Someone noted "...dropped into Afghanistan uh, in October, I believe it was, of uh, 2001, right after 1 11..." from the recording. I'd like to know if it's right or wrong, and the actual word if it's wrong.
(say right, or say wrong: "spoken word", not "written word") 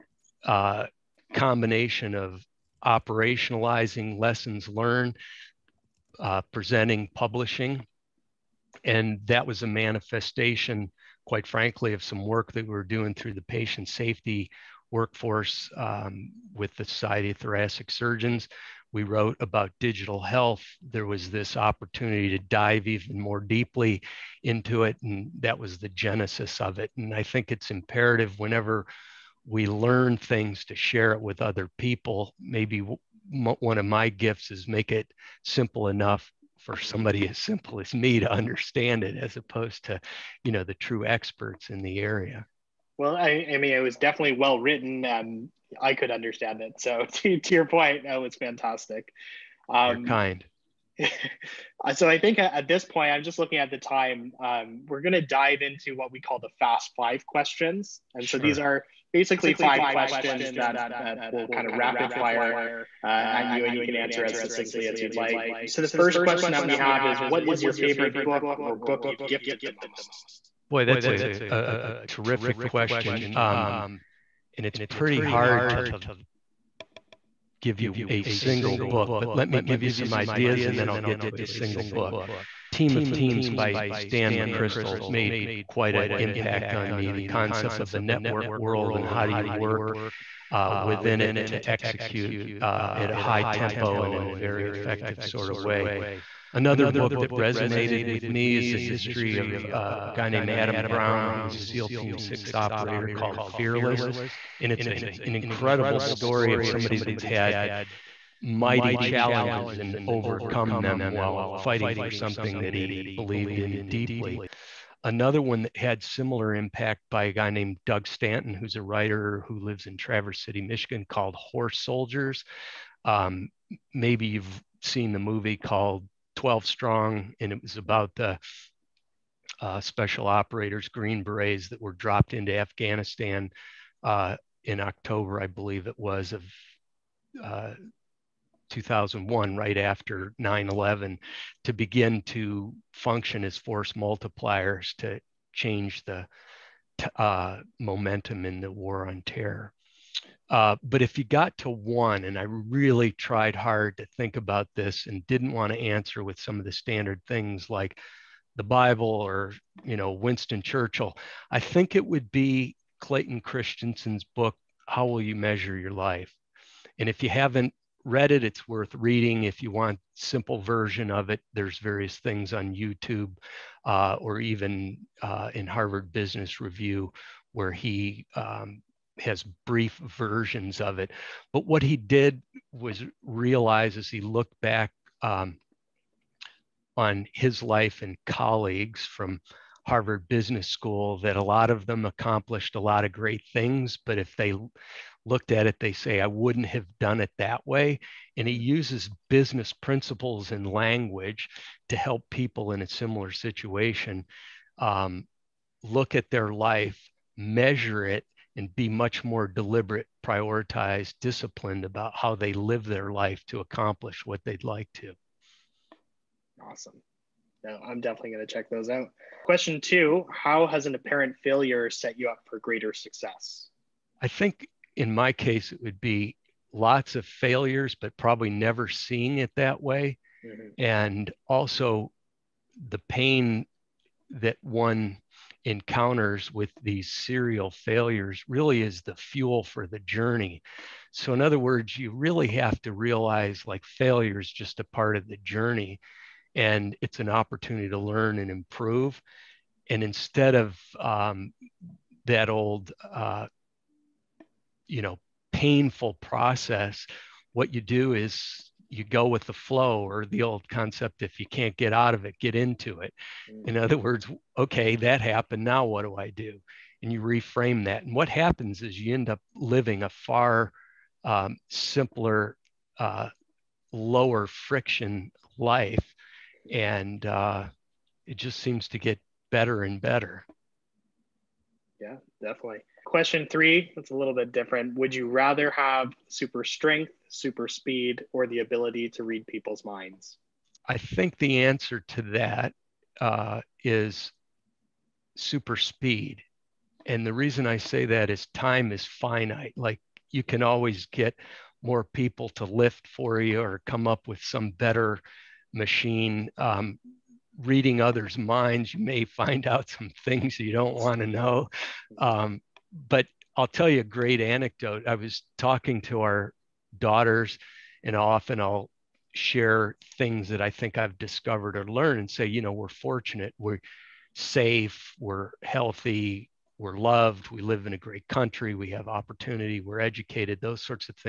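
wrong: "9", not "1".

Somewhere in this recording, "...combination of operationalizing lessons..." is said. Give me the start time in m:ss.
0:01.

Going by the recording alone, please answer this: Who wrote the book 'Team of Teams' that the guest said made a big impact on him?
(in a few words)
Stan McChrystal.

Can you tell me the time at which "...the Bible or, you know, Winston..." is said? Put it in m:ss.
2:38.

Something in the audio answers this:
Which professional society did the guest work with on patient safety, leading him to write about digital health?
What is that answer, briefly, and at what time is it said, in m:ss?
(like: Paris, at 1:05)
Society of Thoracic Surgeons, at 0:16.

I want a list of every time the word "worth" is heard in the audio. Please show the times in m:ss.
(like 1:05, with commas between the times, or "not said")
2:48.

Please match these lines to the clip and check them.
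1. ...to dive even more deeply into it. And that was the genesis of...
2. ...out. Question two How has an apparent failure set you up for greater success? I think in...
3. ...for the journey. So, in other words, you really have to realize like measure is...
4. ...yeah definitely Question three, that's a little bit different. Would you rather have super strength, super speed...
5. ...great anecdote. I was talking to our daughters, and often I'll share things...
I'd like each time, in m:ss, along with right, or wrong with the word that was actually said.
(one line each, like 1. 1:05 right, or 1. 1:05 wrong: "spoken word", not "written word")
1. 0:22 right
2. 3:38 right
3. 3:59 wrong: "failure", not "measure"
4. 4:41 right
5. 5:14 right.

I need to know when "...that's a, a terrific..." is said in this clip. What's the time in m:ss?
1:10.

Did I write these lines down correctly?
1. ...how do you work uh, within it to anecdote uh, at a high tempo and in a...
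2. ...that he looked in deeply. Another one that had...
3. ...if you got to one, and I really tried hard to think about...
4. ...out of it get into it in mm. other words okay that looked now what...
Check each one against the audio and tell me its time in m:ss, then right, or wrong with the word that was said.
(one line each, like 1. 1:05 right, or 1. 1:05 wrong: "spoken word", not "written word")
1. 1:29 wrong: "execute", not "anecdote"
2. 1:52 wrong: "believed", not "looked"
3. 2:31 right
4. 4:21 wrong: "happened", not "looked".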